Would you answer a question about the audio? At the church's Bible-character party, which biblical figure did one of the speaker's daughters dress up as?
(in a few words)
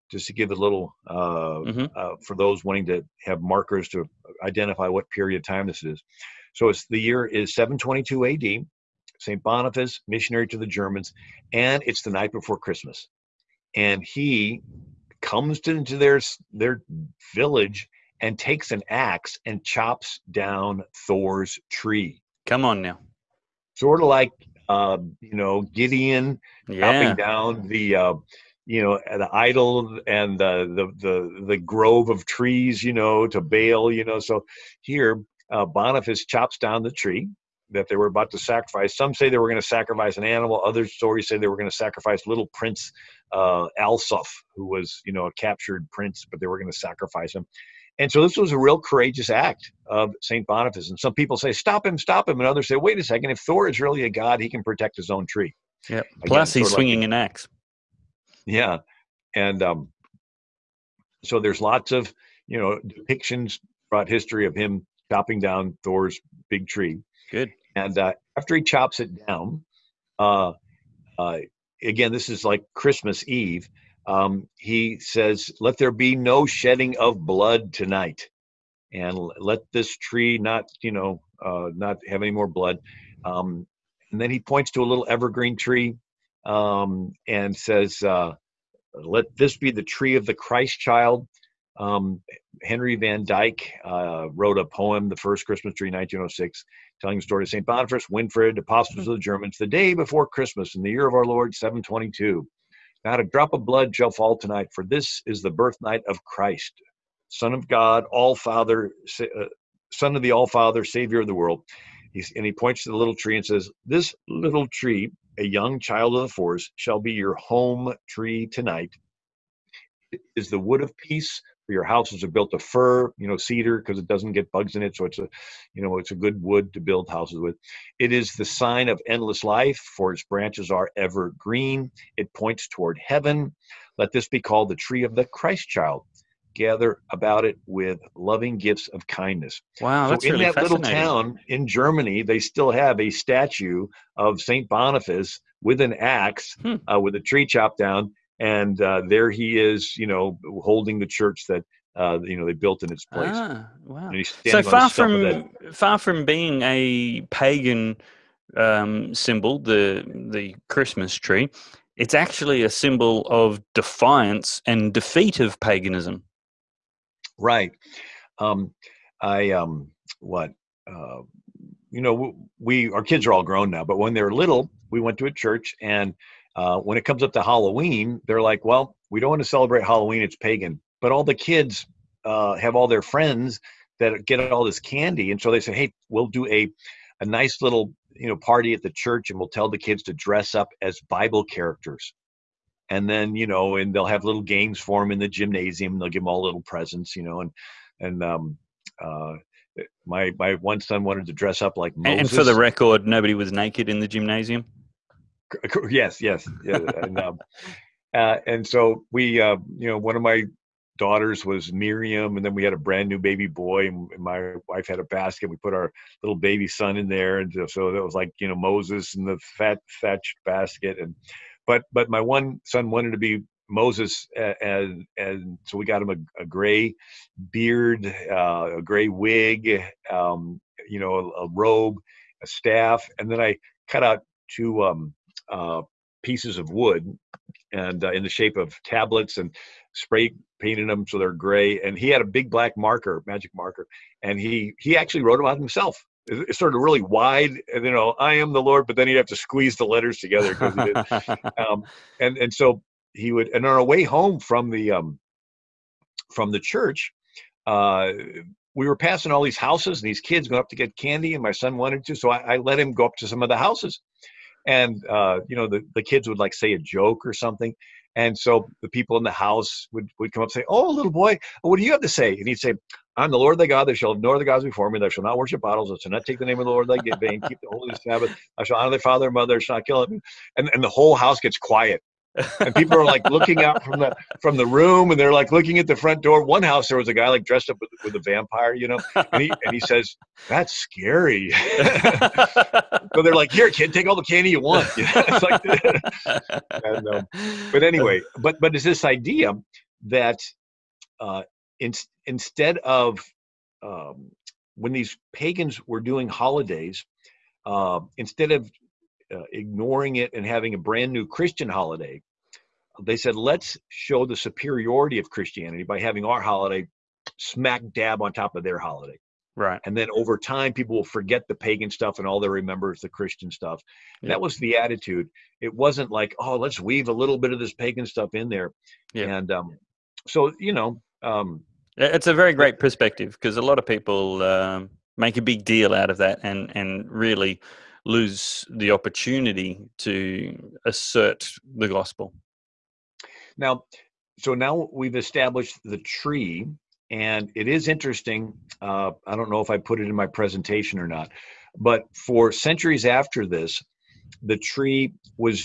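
Miriam.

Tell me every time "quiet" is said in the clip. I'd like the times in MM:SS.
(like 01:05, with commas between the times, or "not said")
04:41.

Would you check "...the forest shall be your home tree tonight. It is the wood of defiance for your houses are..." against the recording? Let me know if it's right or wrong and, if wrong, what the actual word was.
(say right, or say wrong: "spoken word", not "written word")
wrong: "peace", not "defiance".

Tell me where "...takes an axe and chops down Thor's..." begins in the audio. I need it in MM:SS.
00:18.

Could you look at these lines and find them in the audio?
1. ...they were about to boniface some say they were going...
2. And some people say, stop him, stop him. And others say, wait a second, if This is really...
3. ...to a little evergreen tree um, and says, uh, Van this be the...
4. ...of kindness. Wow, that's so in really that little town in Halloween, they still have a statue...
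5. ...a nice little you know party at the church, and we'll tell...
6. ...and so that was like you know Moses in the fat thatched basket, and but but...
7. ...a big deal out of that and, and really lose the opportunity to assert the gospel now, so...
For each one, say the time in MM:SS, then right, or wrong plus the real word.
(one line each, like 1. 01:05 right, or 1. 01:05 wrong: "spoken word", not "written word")
1. 00:37 wrong: "sacrifice", not "boniface"
2. 00:50 wrong: "Thor", not "This"
3. 01:24 wrong: "Let", not "Van"
4. 02:18 wrong: "Germany", not "Halloween"
5. 03:07 right
6. 03:37 right
7. 05:35 right.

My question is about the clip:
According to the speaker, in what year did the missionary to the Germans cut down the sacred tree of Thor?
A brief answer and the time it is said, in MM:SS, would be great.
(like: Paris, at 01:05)
722 AD, at 00:07.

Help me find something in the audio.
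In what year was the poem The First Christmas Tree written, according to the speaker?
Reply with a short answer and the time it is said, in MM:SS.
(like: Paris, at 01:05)
1906, at 01:35.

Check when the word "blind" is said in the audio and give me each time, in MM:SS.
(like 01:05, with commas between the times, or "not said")
not said.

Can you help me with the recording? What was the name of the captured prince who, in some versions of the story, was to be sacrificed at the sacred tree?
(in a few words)
Alsuf.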